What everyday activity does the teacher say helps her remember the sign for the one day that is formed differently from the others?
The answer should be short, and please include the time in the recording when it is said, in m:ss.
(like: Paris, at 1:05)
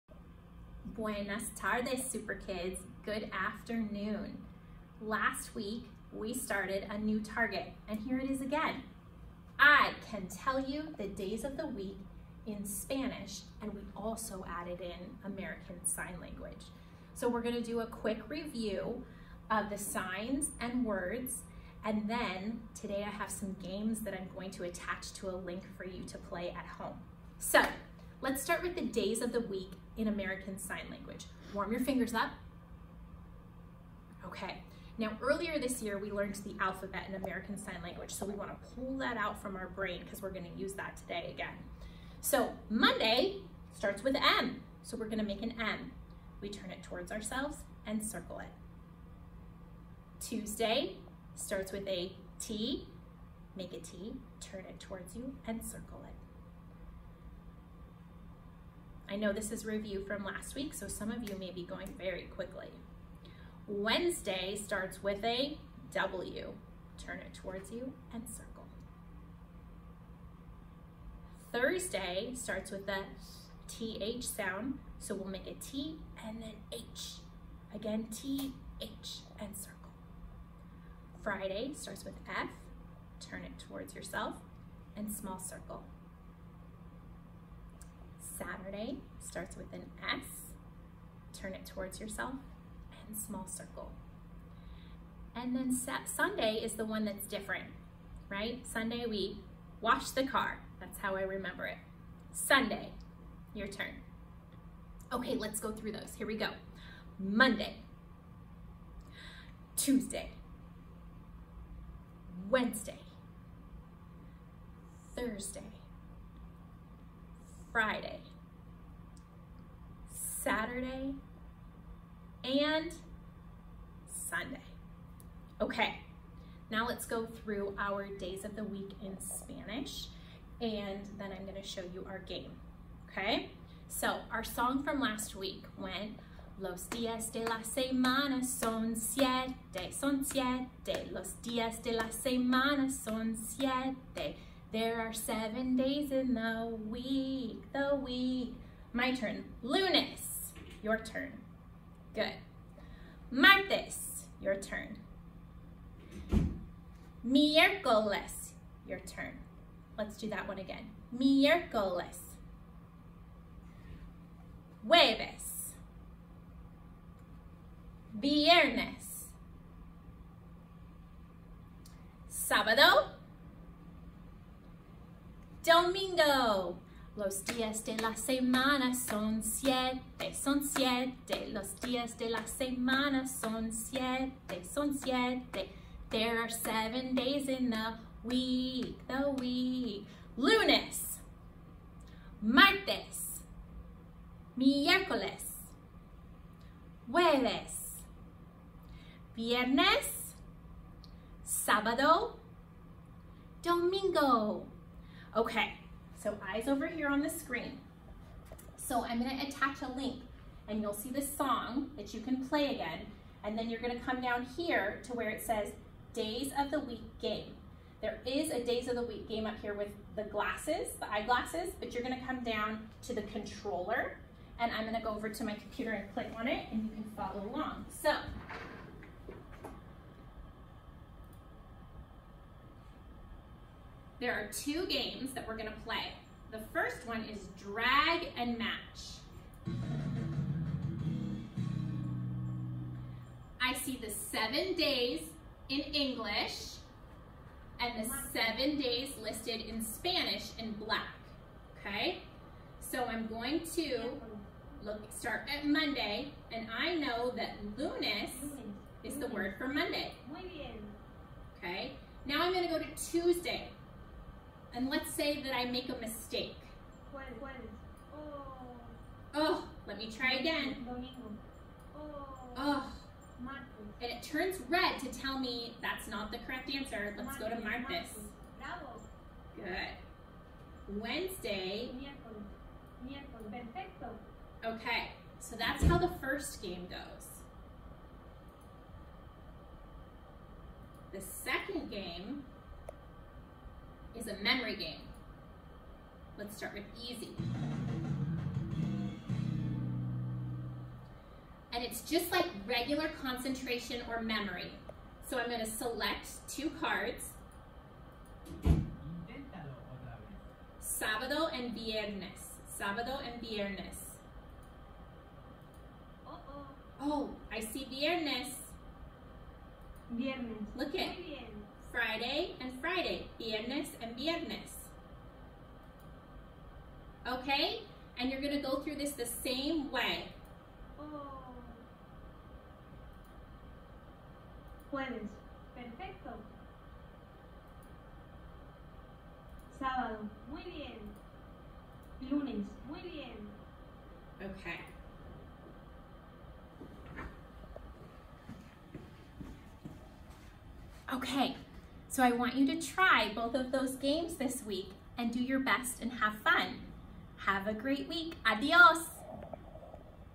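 wash the car, at 1:39.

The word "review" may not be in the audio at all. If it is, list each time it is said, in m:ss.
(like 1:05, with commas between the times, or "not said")
0:18, 0:59.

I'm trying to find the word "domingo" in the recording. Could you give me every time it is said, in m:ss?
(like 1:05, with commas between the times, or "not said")
2:55, 3:23, 4:30.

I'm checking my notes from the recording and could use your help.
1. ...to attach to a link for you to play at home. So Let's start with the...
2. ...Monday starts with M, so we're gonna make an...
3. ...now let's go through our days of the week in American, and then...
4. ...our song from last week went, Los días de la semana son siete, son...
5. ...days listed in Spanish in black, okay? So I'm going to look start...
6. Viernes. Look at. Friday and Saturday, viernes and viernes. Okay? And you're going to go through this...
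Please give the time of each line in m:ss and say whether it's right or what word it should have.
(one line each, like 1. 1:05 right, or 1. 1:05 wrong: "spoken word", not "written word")
1. 0:24 right
2. 0:42 right
3. 2:06 wrong: "Spanish", not "American"
4. 2:14 right
5. 4:08 right
6. 5:20 wrong: "Friday", not "Saturday".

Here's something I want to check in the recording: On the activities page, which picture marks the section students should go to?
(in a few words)
the controller.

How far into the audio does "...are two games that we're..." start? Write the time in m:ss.
3:54.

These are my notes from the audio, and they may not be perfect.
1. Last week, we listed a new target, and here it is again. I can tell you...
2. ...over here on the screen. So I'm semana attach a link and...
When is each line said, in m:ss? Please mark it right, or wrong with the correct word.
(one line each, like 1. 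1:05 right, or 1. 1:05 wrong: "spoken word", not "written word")
1. 0:05 wrong: "started", not "listed"
2. 3:26 wrong: "gonna", not "semana".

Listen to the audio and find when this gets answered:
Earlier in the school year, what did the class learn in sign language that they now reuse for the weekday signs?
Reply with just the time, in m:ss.
0:36.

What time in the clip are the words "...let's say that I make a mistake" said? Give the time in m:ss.
4:24.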